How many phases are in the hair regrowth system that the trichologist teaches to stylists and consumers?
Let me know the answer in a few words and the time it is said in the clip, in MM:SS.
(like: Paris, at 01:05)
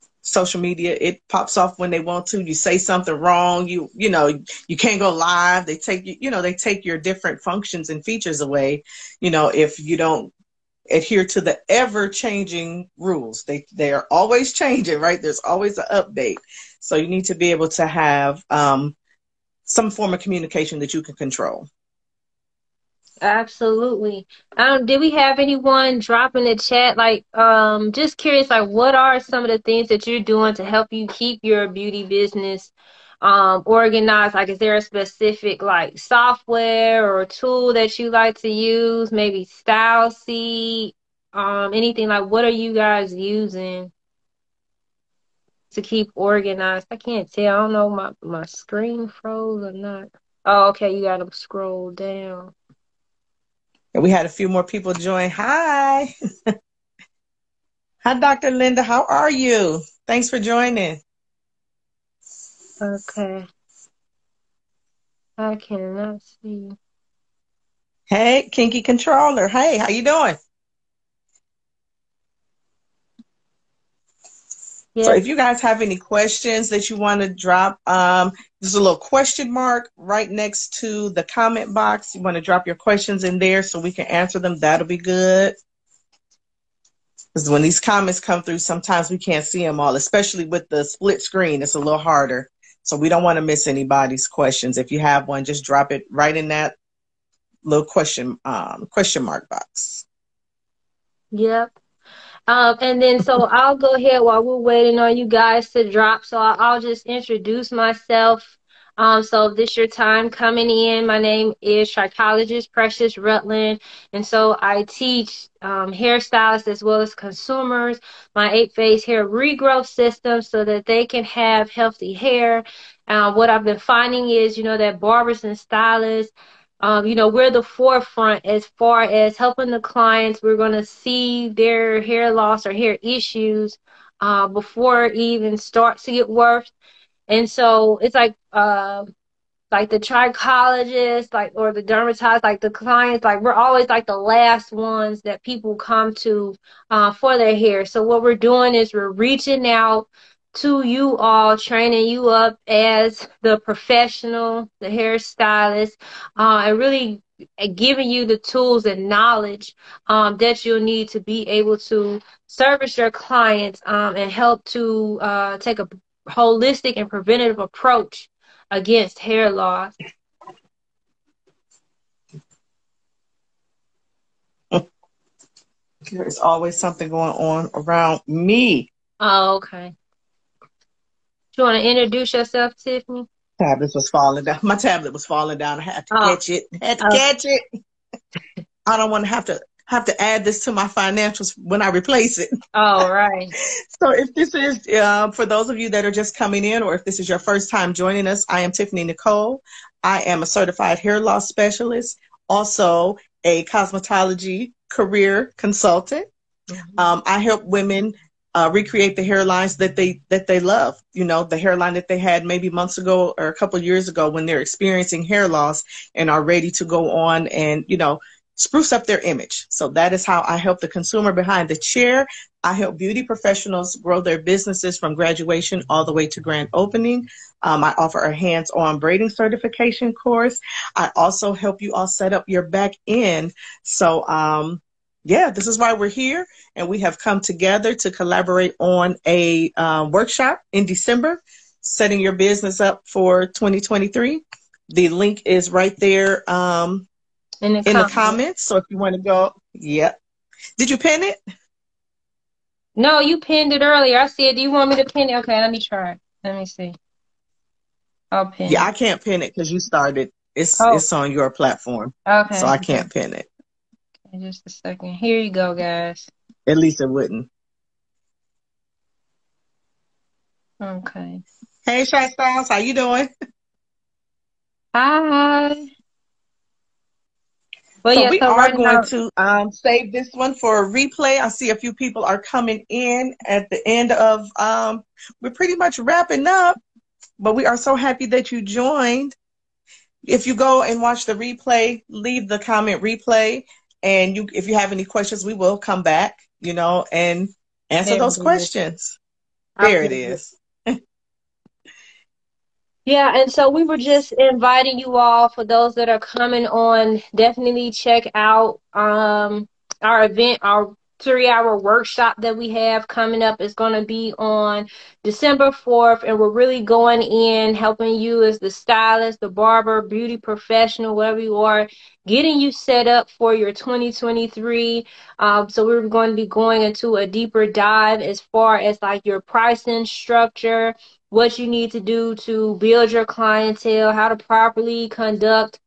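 8, at 01:58.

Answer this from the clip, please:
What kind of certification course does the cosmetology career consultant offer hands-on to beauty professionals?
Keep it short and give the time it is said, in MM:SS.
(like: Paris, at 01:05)
Braiding certification, at 03:48.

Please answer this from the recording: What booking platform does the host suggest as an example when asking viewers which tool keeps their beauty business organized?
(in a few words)
StyleSeat.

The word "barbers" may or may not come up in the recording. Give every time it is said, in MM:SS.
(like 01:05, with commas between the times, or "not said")
02:05, 05:19.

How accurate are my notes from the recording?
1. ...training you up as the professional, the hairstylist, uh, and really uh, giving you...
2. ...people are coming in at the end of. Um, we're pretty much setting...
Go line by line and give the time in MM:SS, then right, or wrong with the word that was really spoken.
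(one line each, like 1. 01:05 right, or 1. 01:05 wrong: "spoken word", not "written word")
1. 02:31 right
2. 04:41 wrong: "wrapping", not "setting".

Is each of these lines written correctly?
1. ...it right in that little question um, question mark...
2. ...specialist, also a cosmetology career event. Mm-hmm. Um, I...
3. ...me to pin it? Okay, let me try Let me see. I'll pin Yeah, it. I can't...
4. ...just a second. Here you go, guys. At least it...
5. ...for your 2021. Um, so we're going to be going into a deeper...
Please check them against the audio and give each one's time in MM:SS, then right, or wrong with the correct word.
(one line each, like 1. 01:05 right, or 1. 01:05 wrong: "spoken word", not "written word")
1. 01:35 right
2. 03:21 wrong: "consultant", not "event"
3. 04:14 right
4. 04:24 right
5. 05:23 wrong: "2023", not "2021".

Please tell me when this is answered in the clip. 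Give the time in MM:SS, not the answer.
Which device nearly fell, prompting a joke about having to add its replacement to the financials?
03:04.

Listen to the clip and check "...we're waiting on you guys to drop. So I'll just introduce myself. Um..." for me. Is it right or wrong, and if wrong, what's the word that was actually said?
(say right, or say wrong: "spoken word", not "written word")
right.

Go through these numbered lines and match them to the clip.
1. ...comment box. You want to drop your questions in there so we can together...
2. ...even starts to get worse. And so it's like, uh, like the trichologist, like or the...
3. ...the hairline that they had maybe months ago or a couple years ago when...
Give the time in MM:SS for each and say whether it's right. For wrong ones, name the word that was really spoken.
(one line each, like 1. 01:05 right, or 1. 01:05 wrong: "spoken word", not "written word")
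1. 01:21 wrong: "answer", not "together"
2. 02:15 right
3. 03:31 right.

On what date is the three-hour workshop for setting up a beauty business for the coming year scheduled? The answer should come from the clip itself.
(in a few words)
December 4th.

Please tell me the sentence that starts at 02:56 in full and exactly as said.
There's always something going on around me.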